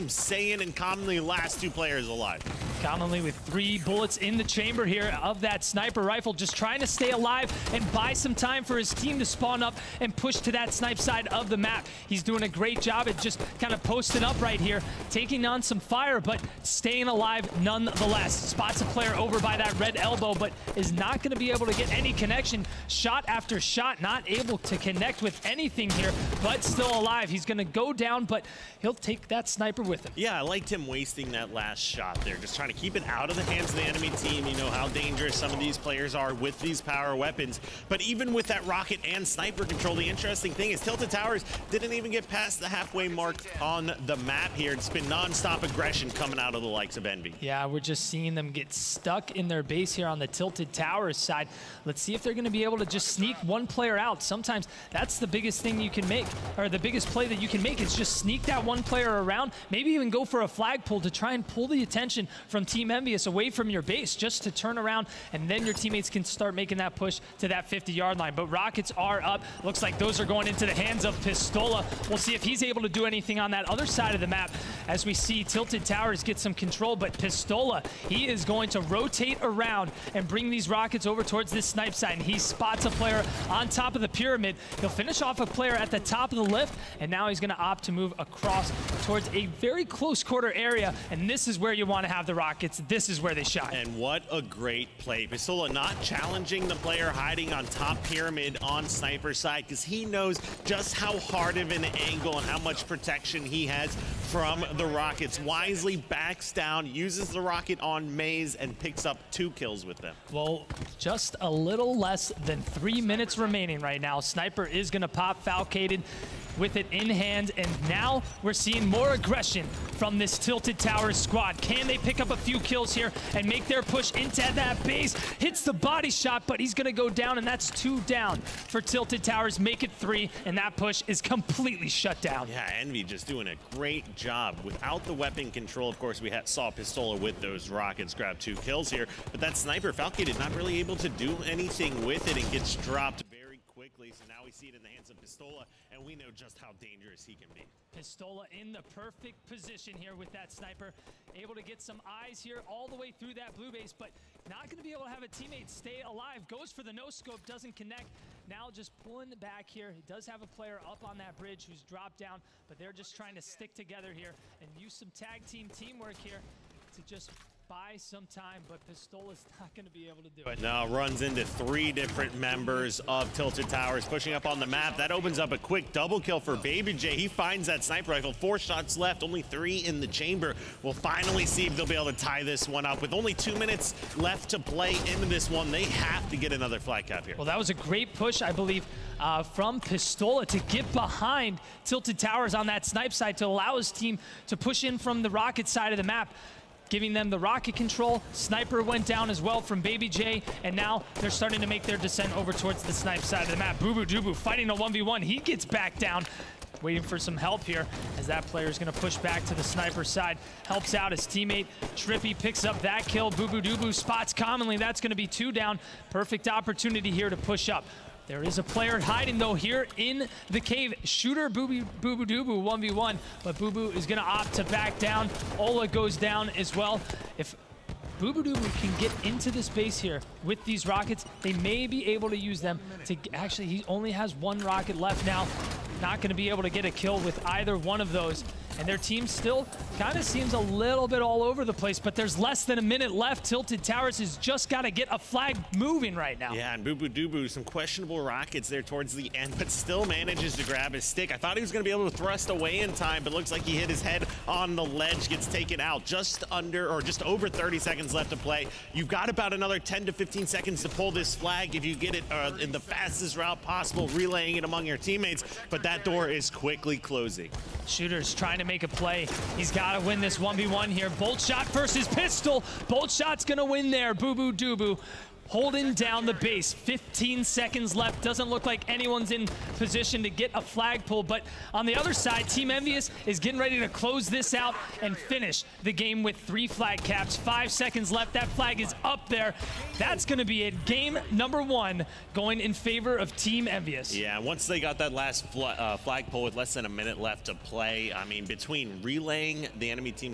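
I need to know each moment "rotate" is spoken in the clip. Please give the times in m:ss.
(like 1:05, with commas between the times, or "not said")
1:18.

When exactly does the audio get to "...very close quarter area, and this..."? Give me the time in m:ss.
1:29.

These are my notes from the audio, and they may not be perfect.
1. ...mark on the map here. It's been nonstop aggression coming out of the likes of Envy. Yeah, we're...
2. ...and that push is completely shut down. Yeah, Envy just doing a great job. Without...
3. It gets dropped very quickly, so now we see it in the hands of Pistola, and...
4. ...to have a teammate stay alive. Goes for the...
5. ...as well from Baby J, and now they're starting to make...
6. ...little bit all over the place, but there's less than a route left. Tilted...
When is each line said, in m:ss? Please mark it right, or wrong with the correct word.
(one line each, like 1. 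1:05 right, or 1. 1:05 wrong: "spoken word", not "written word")
1. 0:43 right
2. 2:10 right
3. 2:22 right
4. 2:35 right
5. 3:19 right
6. 4:00 wrong: "minute", not "route".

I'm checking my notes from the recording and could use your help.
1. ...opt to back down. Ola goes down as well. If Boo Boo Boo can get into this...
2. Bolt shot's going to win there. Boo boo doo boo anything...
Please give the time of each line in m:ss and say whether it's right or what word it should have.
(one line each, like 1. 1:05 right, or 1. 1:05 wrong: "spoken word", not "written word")
1. 3:44 right
2. 4:32 wrong: "holding", not "anything".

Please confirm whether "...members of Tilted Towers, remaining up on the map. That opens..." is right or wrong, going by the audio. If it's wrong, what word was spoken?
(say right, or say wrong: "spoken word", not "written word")
wrong: "pushing", not "remaining".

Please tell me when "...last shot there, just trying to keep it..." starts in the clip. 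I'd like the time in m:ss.
0:31.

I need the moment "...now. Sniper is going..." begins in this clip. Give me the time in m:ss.
1:54.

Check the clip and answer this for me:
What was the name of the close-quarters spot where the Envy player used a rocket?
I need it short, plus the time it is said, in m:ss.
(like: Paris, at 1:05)
Maze, at 1:48.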